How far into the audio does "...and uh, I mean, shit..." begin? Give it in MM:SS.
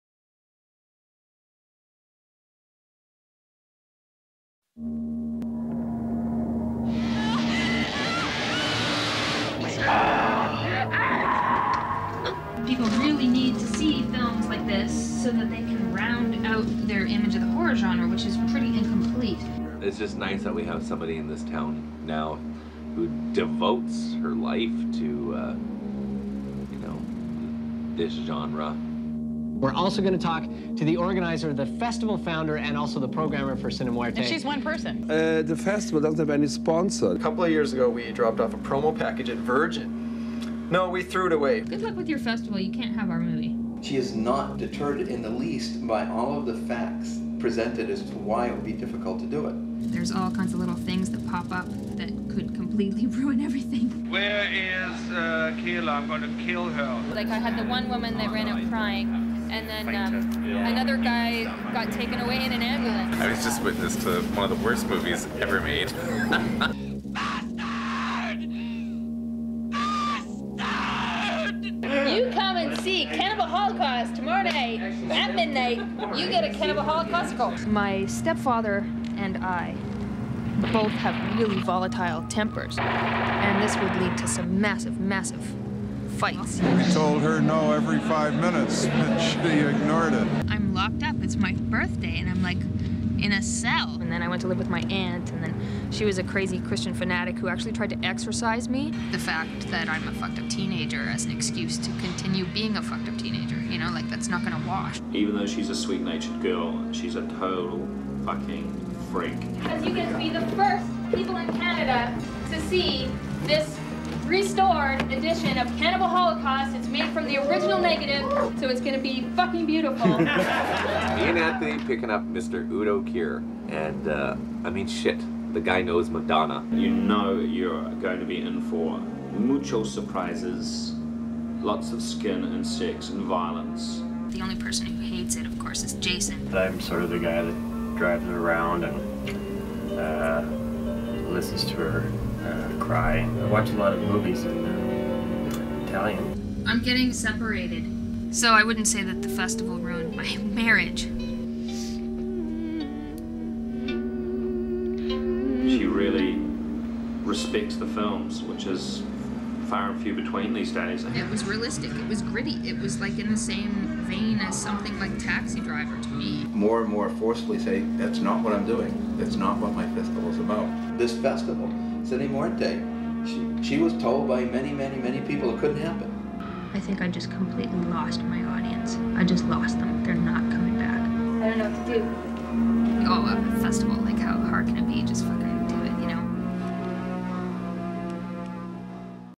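02:03.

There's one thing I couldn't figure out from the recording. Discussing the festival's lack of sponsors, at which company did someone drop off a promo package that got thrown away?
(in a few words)
Virgin.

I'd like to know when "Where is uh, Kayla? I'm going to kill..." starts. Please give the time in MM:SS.
00:54.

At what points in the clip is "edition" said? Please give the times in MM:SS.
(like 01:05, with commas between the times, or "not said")
01:55.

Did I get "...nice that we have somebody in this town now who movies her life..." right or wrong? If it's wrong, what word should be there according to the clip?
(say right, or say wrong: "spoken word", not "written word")
wrong: "devotes", not "movies".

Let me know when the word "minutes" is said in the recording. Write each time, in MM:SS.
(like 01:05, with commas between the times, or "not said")
01:28.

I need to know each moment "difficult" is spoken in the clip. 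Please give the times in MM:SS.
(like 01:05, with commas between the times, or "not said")
00:48.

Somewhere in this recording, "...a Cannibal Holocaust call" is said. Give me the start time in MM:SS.
01:16.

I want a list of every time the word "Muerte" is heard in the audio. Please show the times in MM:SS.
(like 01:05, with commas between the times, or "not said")
00:33, 02:52.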